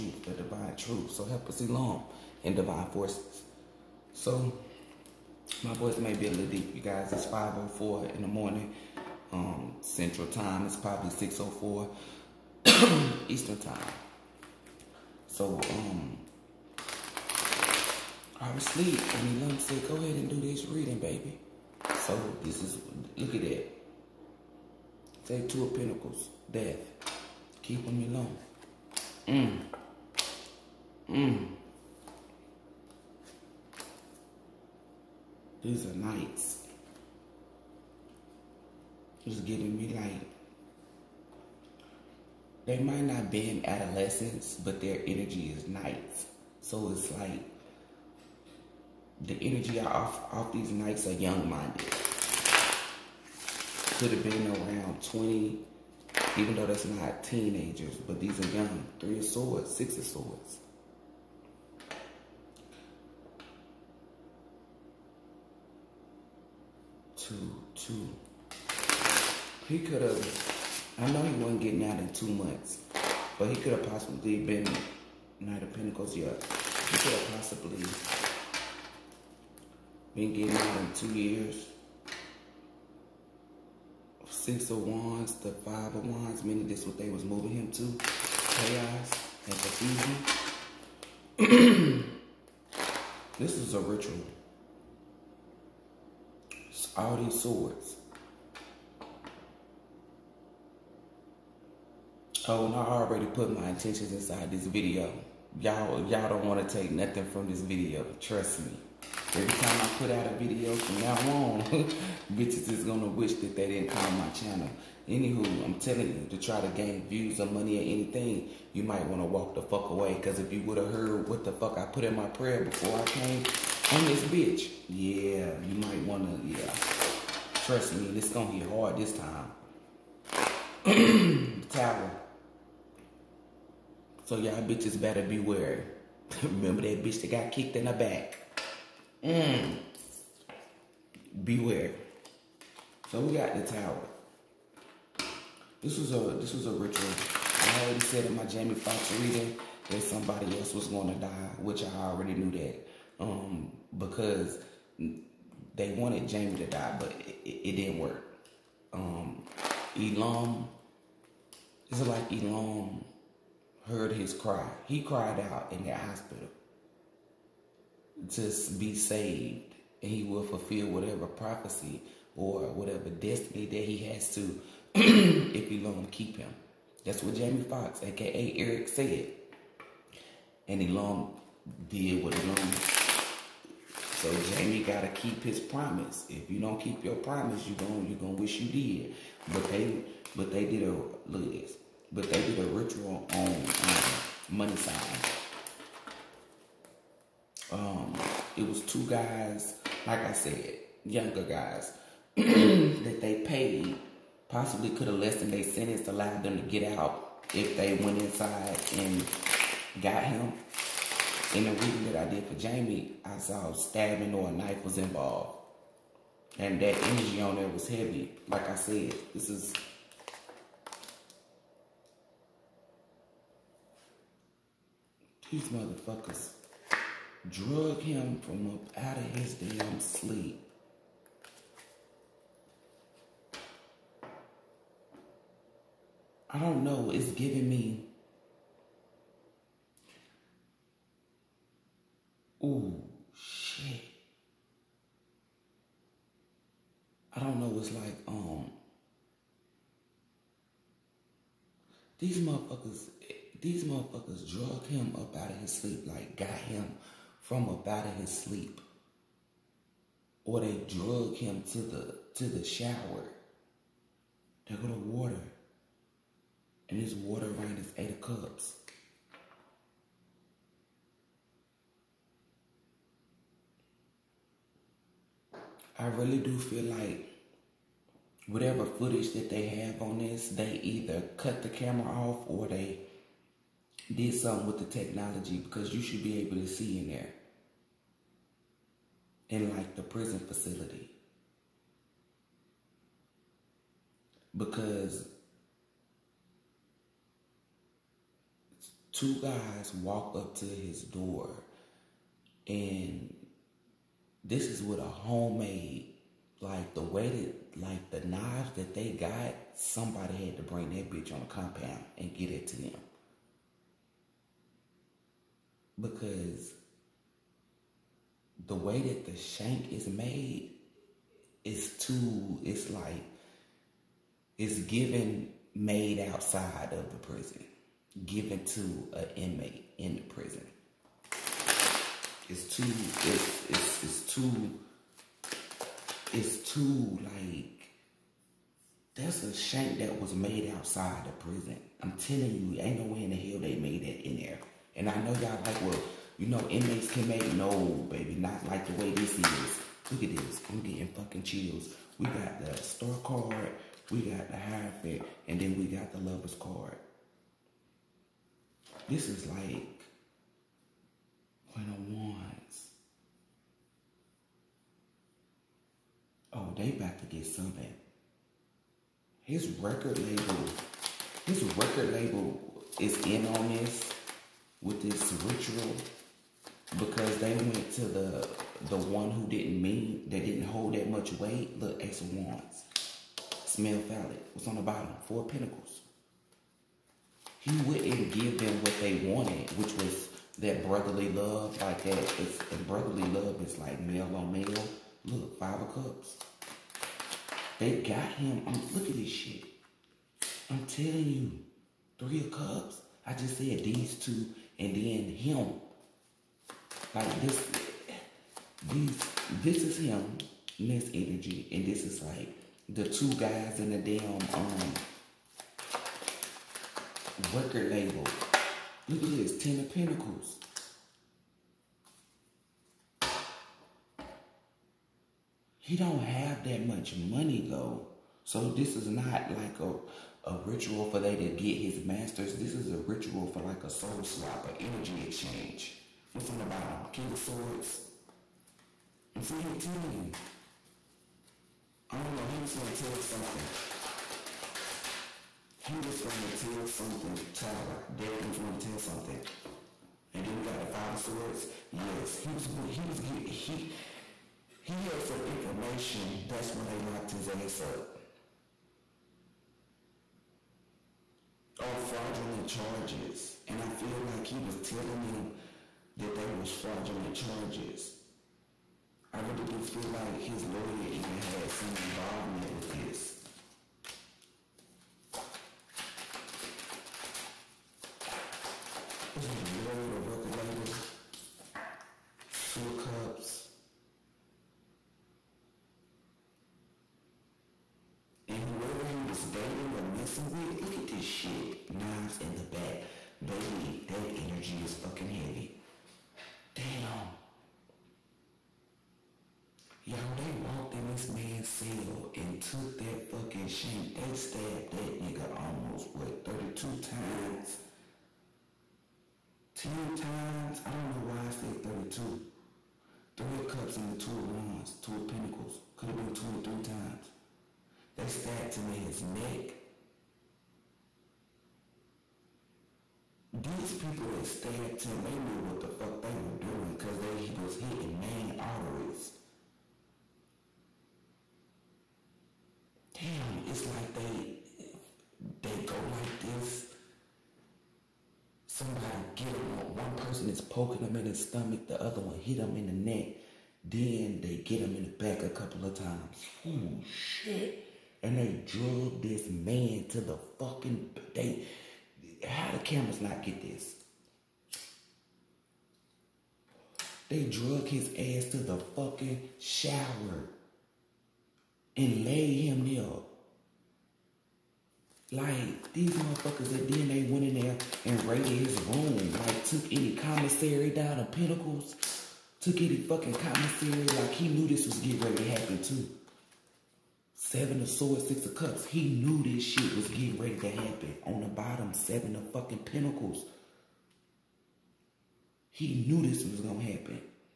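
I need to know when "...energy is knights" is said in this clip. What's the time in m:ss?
0:45.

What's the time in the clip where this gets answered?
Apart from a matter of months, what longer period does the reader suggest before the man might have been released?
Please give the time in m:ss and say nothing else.
1:20.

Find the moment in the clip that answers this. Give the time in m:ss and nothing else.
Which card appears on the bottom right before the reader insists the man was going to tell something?
7:17.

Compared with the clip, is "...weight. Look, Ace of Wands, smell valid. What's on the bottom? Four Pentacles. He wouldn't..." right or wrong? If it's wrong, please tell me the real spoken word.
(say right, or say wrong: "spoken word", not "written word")
right.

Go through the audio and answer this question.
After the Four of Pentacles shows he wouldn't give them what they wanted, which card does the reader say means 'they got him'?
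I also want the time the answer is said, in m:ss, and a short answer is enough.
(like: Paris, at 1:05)
Five of Cups, at 6:35.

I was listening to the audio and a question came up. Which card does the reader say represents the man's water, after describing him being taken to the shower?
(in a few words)
Eight of Cups.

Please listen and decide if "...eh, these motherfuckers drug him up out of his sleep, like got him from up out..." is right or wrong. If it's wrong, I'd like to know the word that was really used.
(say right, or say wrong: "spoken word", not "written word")
right.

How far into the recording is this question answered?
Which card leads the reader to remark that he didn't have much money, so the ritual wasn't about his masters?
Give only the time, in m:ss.
6:59.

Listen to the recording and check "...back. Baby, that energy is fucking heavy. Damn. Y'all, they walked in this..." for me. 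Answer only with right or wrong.
right.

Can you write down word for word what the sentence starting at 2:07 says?
Trust me, it's gonna hit hard this time.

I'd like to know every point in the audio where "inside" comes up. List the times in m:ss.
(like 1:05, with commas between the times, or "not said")
1:44, 3:28.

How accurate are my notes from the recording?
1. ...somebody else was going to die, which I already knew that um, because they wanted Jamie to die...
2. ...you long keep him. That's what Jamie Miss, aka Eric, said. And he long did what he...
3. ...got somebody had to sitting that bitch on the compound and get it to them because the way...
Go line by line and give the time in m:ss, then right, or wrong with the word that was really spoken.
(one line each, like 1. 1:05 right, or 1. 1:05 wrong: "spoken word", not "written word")
1. 2:30 right
2. 2:55 wrong: "Foxx", not "Miss"
3. 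5:09 wrong: "bring", not "sitting".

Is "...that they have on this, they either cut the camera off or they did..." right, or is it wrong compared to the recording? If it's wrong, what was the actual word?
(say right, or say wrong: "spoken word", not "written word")
right.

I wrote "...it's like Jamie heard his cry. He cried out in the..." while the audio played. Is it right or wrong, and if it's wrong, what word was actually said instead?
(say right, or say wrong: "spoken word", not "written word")
wrong: "Elohym", not "Jamie".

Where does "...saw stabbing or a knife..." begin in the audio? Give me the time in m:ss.
3:33.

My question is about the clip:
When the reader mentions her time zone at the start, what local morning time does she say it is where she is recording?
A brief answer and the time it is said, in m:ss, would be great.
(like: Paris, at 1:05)
5:04, at 0:07.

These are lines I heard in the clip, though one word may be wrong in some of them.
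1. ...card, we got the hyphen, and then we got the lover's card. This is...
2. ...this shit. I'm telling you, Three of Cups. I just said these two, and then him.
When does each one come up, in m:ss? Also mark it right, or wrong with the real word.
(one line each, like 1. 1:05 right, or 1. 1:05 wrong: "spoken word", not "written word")
1. 5:53 right
2. 6:39 right.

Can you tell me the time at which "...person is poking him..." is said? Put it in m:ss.
9:00.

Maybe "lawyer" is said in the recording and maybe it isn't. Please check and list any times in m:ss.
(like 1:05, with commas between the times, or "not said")
7:50, 7:59.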